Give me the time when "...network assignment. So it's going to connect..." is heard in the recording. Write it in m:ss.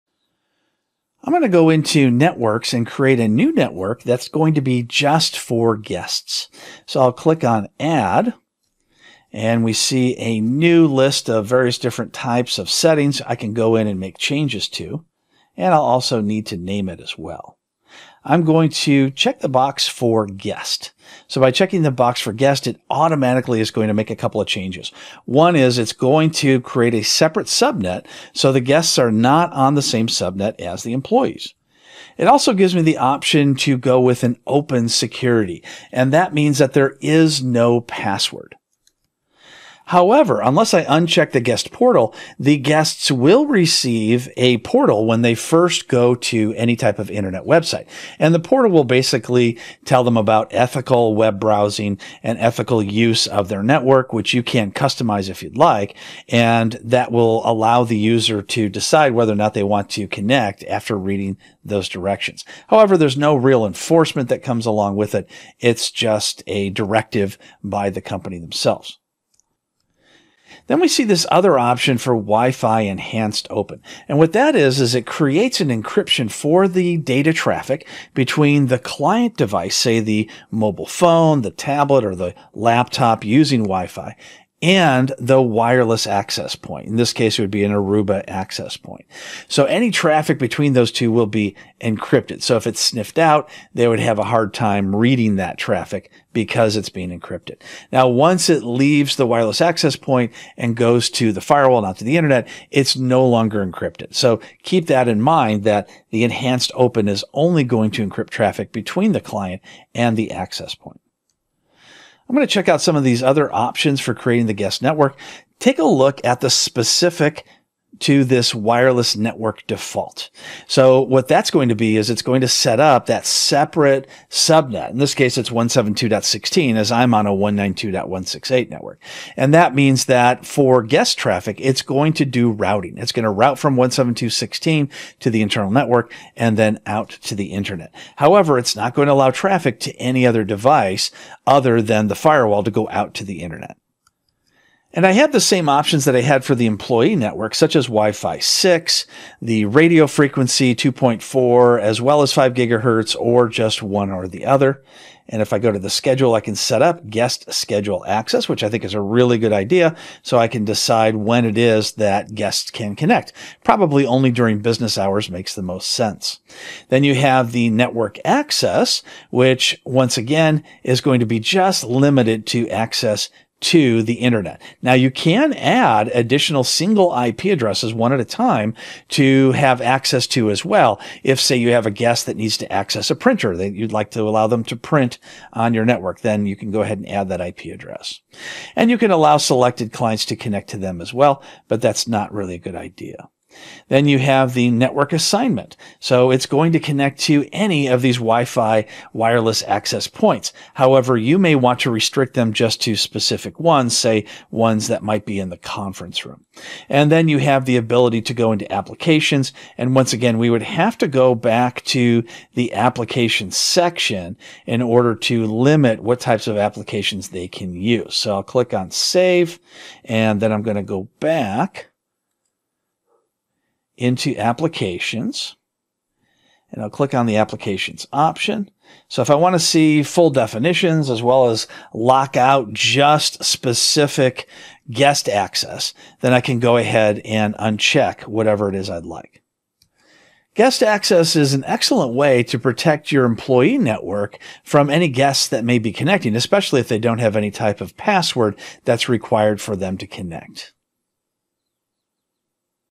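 3:14.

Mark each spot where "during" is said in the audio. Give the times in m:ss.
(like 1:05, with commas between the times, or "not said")
2:44.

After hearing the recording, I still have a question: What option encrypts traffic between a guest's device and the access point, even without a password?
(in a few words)
Wi-Fi enhanced open.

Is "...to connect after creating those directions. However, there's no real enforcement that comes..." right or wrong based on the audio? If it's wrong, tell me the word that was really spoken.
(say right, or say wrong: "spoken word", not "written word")
wrong: "reading", not "creating".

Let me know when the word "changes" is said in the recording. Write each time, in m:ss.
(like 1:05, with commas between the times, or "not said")
0:14, 0:24.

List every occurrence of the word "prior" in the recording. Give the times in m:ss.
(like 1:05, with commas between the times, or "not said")
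not said.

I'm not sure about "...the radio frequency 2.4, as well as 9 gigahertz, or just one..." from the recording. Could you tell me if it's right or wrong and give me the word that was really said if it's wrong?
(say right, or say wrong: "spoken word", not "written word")
wrong: "5", not "9".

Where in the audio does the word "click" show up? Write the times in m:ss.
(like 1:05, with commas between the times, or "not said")
0:07, 3:38, 3:46.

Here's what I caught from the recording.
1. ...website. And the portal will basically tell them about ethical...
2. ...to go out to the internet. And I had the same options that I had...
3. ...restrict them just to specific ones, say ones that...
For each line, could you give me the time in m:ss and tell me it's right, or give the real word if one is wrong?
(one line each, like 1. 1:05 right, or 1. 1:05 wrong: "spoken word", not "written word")
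1. 0:47 right
2. 2:22 right
3. 3:21 right.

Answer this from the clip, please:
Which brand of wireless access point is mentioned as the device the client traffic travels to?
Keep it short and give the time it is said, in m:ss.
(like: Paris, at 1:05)
Aruba, at 1:27.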